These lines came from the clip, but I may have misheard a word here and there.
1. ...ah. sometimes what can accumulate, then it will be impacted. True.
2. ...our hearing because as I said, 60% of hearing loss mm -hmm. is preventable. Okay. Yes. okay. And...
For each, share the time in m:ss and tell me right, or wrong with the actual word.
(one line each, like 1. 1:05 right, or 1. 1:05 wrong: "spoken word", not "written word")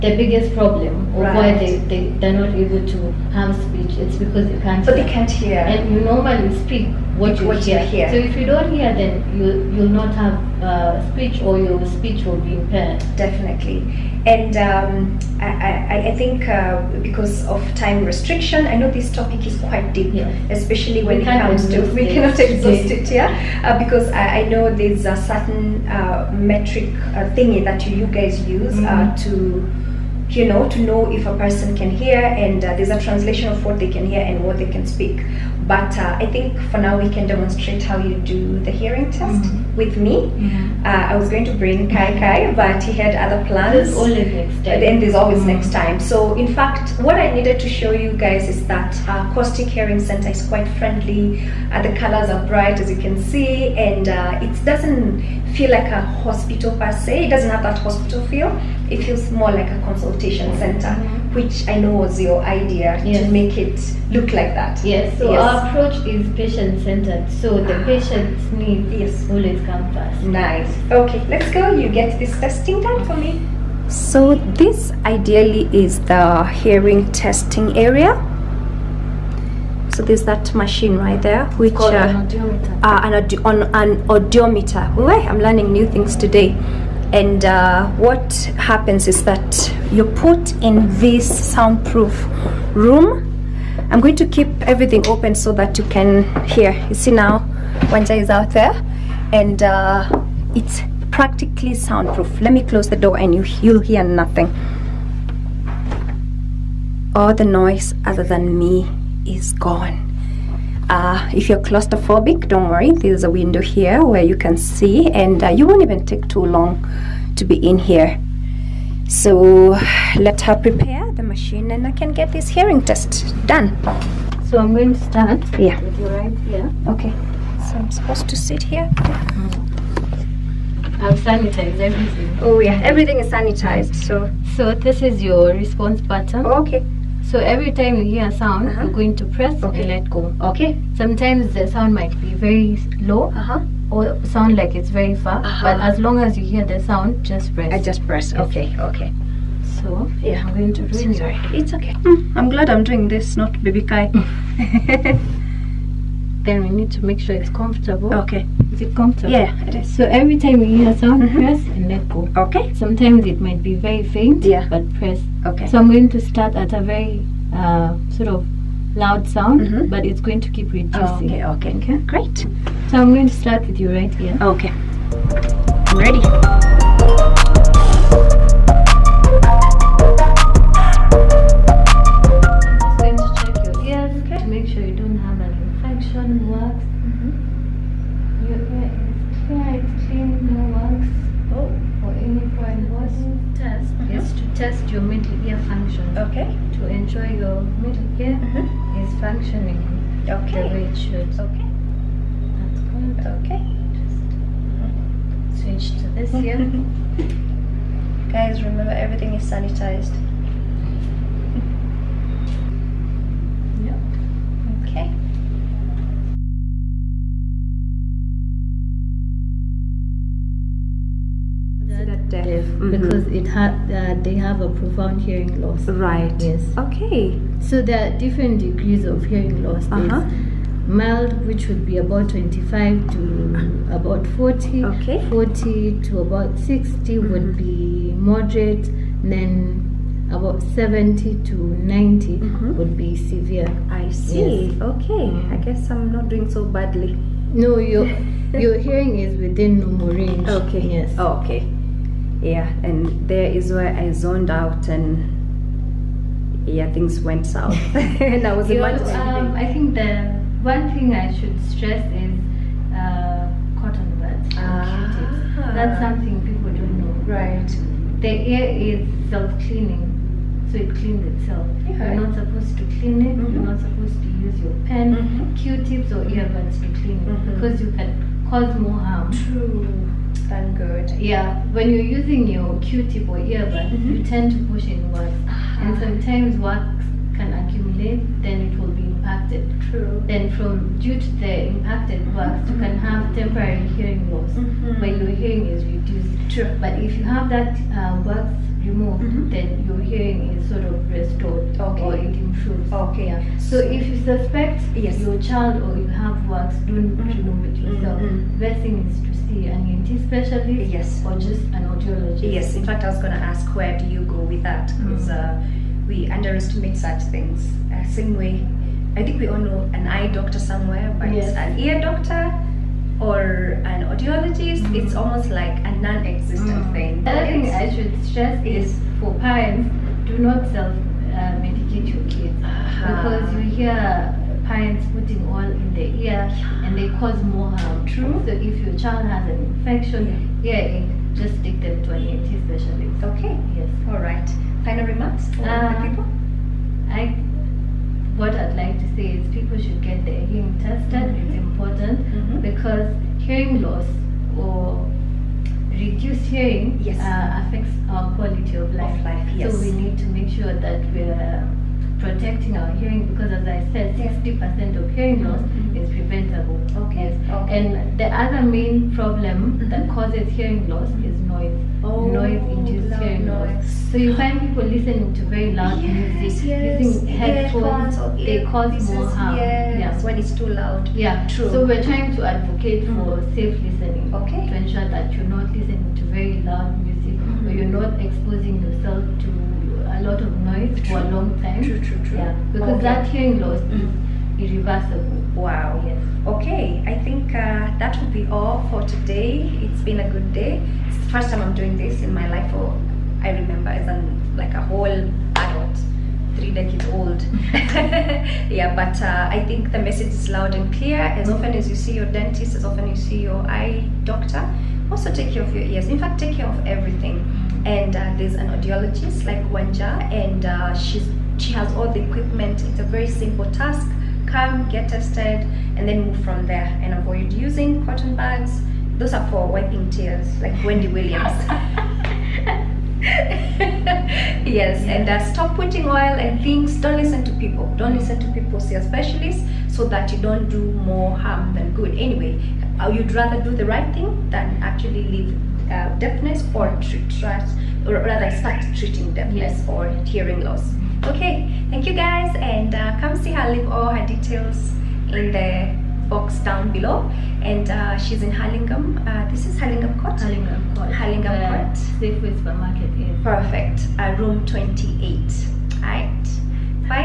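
1. 4:45 right
2. 6:02 right.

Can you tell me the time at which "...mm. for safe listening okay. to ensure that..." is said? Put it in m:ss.
6:23.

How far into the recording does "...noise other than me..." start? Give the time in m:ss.
1:47.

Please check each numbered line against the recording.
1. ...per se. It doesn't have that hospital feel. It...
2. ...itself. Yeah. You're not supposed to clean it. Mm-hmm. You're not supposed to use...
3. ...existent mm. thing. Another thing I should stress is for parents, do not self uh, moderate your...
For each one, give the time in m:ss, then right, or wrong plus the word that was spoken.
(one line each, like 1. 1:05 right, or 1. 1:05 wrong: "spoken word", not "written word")
1. 0:56 right
2. 4:31 right
3. 5:26 wrong: "medicate", not "moderate".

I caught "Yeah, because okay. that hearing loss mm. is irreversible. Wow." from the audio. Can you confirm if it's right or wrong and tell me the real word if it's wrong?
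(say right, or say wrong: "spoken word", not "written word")
right.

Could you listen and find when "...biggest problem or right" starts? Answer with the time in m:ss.
0:00.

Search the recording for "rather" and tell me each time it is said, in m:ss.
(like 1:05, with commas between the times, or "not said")
7:23, 7:28.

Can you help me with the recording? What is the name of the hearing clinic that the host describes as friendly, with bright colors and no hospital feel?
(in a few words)
Acoustic Hearing Center.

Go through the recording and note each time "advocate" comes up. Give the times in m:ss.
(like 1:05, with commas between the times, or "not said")
6:22.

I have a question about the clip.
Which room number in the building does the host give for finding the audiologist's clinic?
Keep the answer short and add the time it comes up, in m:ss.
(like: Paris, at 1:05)
28, at 7:44.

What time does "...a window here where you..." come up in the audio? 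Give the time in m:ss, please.
1:53.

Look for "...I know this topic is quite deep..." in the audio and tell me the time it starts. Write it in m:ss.
0:18.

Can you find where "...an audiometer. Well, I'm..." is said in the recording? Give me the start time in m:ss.
1:23.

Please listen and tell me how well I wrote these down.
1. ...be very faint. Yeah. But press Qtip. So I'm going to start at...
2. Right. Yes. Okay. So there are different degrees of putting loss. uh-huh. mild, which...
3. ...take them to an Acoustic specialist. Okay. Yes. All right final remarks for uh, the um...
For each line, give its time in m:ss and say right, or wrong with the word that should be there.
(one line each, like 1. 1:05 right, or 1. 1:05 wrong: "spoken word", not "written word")
1. 2:43 wrong: "Okay", not "Qtip"
2. 3:45 wrong: "hearing", not "putting"
3. 5:41 wrong: "ENT", not "Acoustic".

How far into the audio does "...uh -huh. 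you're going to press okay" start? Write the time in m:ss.
2:18.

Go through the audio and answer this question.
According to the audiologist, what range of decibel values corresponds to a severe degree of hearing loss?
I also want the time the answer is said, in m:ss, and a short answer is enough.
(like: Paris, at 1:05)
70 to 90, at 4:00.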